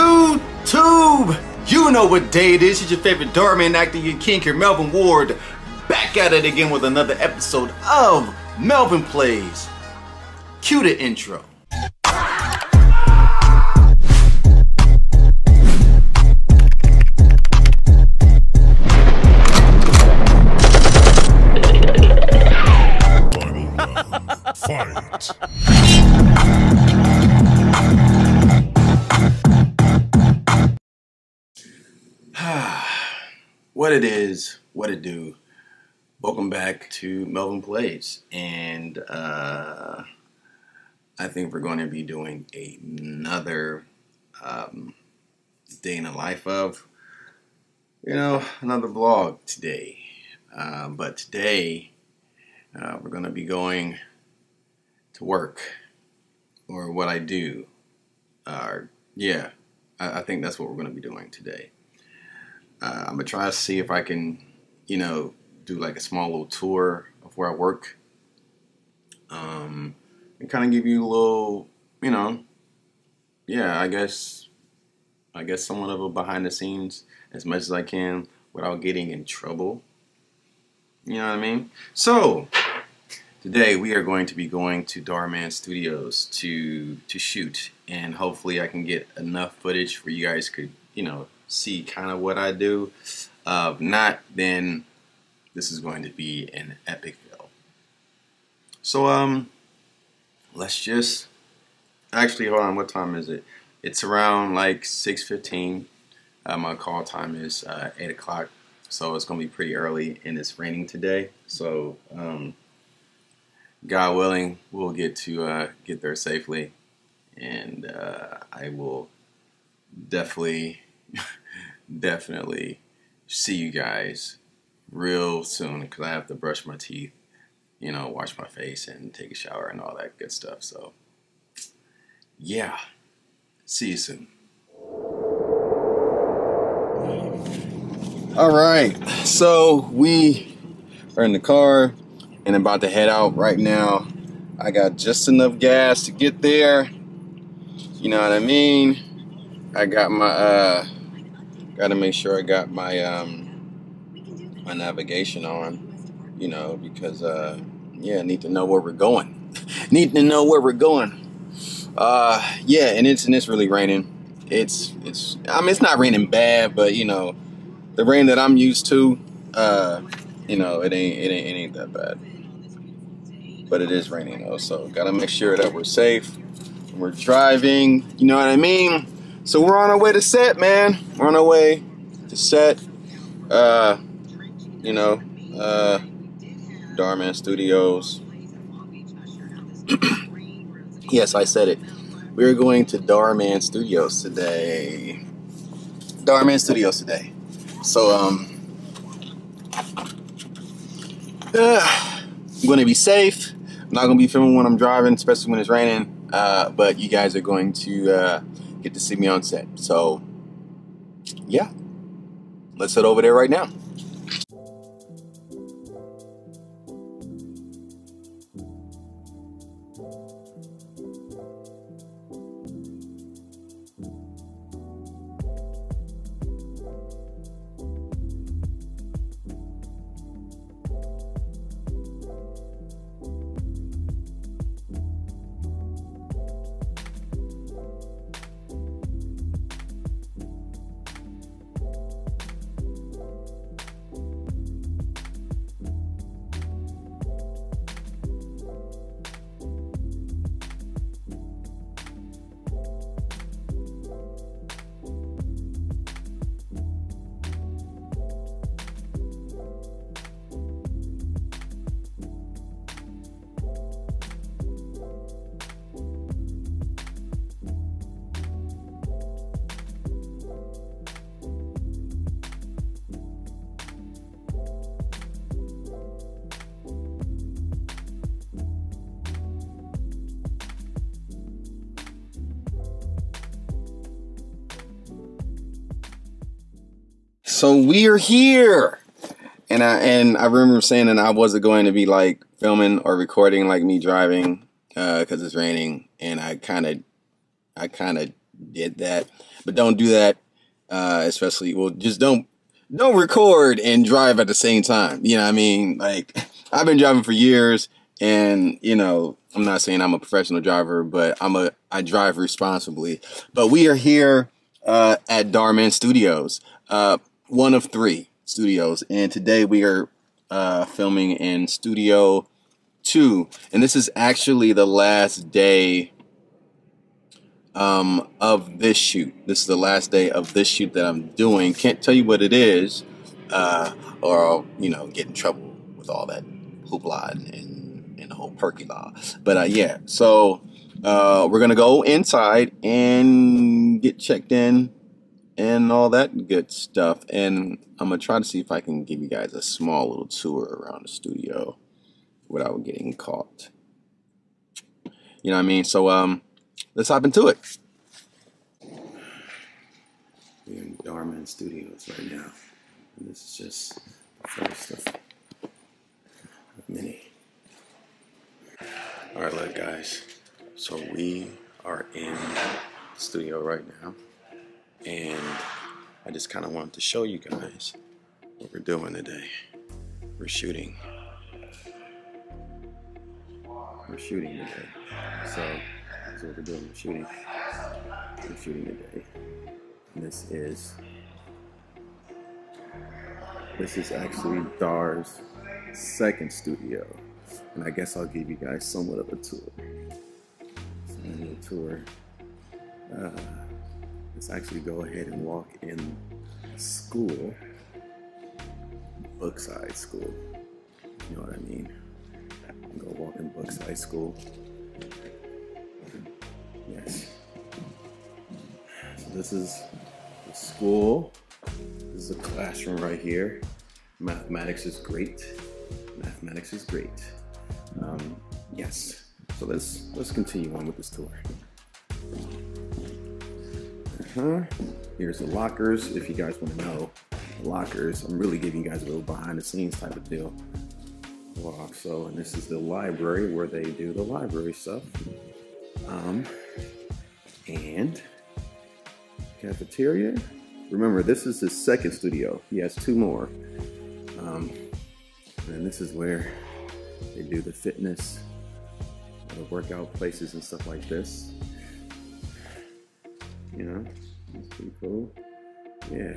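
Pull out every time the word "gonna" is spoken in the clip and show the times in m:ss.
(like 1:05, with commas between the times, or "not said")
1:03, 5:48.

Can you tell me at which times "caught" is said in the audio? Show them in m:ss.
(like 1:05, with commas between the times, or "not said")
5:53.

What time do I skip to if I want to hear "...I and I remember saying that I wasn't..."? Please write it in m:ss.
4:49.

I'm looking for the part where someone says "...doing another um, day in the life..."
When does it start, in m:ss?
0:42.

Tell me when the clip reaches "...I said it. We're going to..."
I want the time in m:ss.
3:11.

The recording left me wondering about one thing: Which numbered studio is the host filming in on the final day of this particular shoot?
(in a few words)
Studio 2.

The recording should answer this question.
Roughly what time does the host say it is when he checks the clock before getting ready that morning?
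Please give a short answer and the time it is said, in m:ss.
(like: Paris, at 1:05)
6:15, at 1:44.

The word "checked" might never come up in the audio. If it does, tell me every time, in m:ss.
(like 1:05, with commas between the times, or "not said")
5:44.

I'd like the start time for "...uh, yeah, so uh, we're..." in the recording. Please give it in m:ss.
5:39.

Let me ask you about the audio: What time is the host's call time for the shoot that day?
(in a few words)
8 o'clock.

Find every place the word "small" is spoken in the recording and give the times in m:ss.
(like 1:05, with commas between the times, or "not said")
1:05, 5:49.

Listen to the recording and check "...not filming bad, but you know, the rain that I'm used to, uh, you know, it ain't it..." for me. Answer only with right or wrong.
wrong.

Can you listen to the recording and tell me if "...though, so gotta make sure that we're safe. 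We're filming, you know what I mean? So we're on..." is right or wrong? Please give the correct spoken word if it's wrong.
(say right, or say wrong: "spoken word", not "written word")
wrong: "driving", not "filming".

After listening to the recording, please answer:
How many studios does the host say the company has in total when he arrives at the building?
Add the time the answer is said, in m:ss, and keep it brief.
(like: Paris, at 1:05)
3, at 5:17.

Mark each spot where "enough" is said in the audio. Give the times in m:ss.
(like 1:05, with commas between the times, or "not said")
1:29, 2:25.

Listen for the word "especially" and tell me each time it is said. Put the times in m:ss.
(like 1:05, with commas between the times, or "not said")
3:25, 5:01.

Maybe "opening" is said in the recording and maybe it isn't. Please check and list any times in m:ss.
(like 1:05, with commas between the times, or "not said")
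not said.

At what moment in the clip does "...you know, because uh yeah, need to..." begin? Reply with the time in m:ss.
2:36.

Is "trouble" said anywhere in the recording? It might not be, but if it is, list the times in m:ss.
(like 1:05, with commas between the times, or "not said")
1:19, 5:35.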